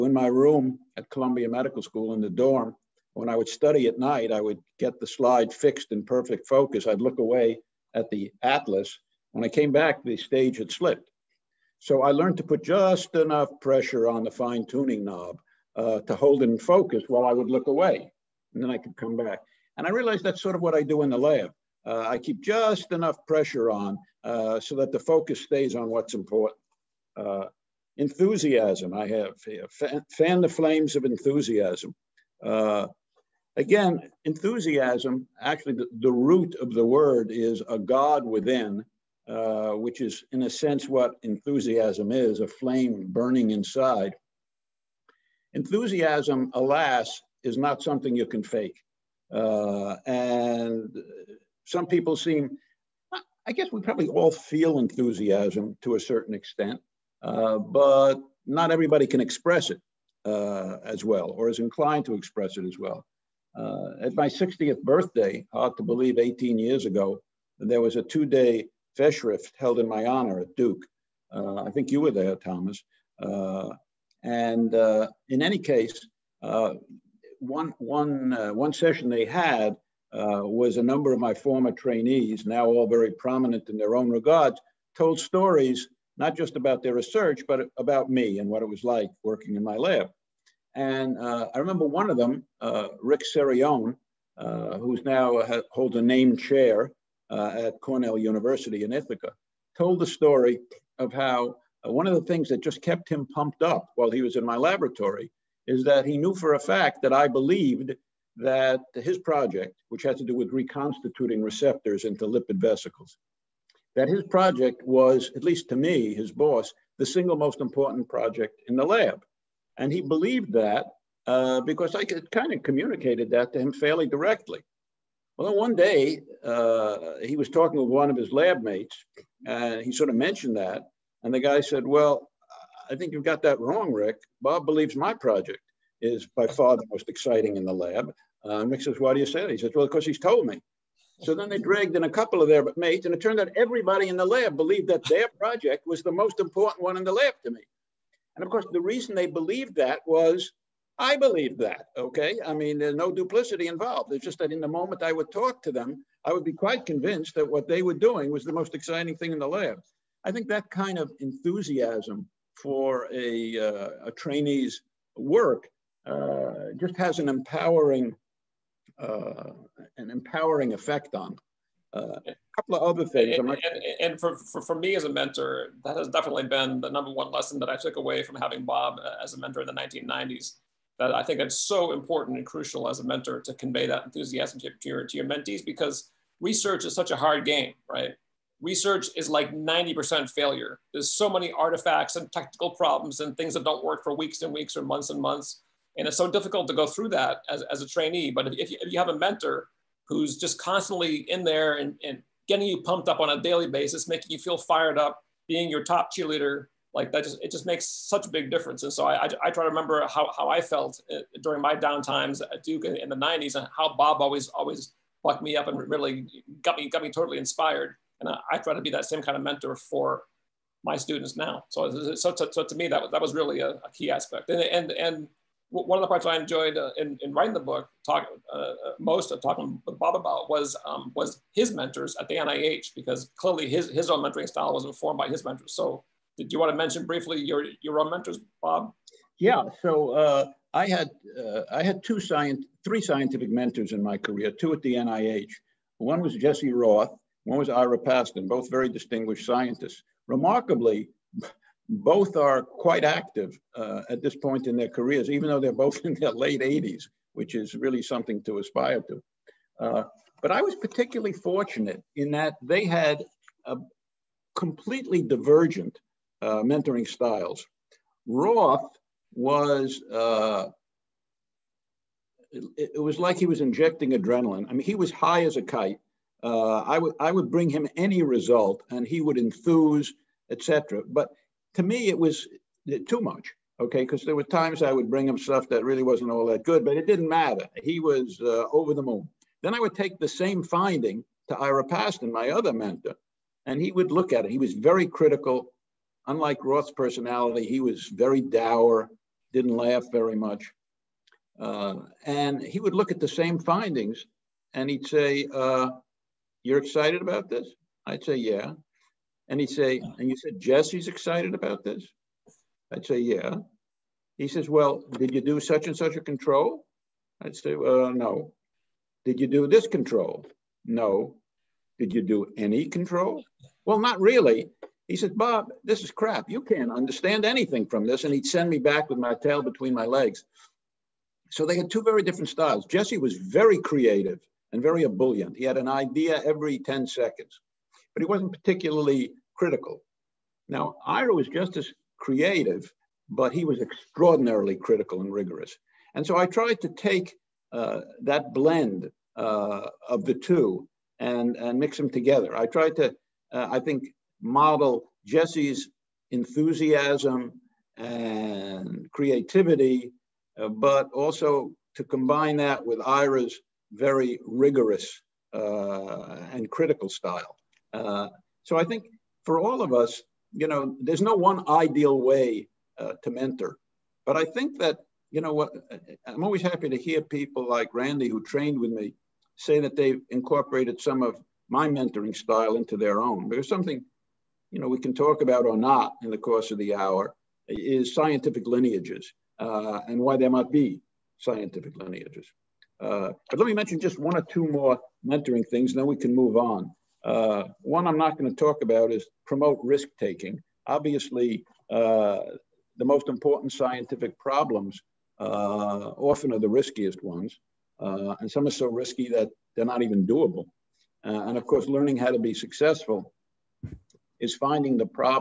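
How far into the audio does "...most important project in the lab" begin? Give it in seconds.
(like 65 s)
117 s.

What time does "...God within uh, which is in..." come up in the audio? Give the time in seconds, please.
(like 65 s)
37 s.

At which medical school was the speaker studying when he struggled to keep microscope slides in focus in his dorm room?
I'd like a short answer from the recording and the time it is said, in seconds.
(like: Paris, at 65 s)
Columbia Medical School, at 1 s.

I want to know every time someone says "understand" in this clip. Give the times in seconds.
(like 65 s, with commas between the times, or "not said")
326 s.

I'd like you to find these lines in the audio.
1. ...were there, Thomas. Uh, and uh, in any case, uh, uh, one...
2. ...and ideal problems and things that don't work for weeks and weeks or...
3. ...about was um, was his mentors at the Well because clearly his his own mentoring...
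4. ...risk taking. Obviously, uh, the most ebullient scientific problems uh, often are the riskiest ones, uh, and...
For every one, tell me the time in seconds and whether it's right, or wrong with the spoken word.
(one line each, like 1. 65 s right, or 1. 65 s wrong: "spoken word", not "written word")
1. 72 s right
2. 192 s wrong: "technical", not "ideal"
3. 230 s wrong: "NIH", not "Well"
4. 399 s wrong: "important", not "ebullient".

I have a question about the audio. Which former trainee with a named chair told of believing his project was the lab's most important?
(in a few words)
Rick Cerione.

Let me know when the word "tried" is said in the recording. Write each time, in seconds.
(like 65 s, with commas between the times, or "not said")
346 s, 352 s.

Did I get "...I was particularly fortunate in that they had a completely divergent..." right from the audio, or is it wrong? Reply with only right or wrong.
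right.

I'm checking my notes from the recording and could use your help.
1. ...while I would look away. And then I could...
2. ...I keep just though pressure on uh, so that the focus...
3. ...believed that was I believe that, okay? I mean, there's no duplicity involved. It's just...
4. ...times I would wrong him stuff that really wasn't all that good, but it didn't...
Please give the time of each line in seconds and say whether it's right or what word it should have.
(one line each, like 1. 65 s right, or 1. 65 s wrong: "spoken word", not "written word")
1. 17 s right
2. 22 s wrong: "enough", not "though"
3. 149 s right
4. 284 s wrong: "bring", not "wrong".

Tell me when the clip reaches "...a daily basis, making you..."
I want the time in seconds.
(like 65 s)
203 s.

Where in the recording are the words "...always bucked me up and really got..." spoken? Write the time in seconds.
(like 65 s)
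214 s.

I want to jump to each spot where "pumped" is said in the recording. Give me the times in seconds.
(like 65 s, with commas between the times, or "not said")
103 s, 202 s.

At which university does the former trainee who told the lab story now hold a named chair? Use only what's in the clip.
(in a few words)
Cornell University.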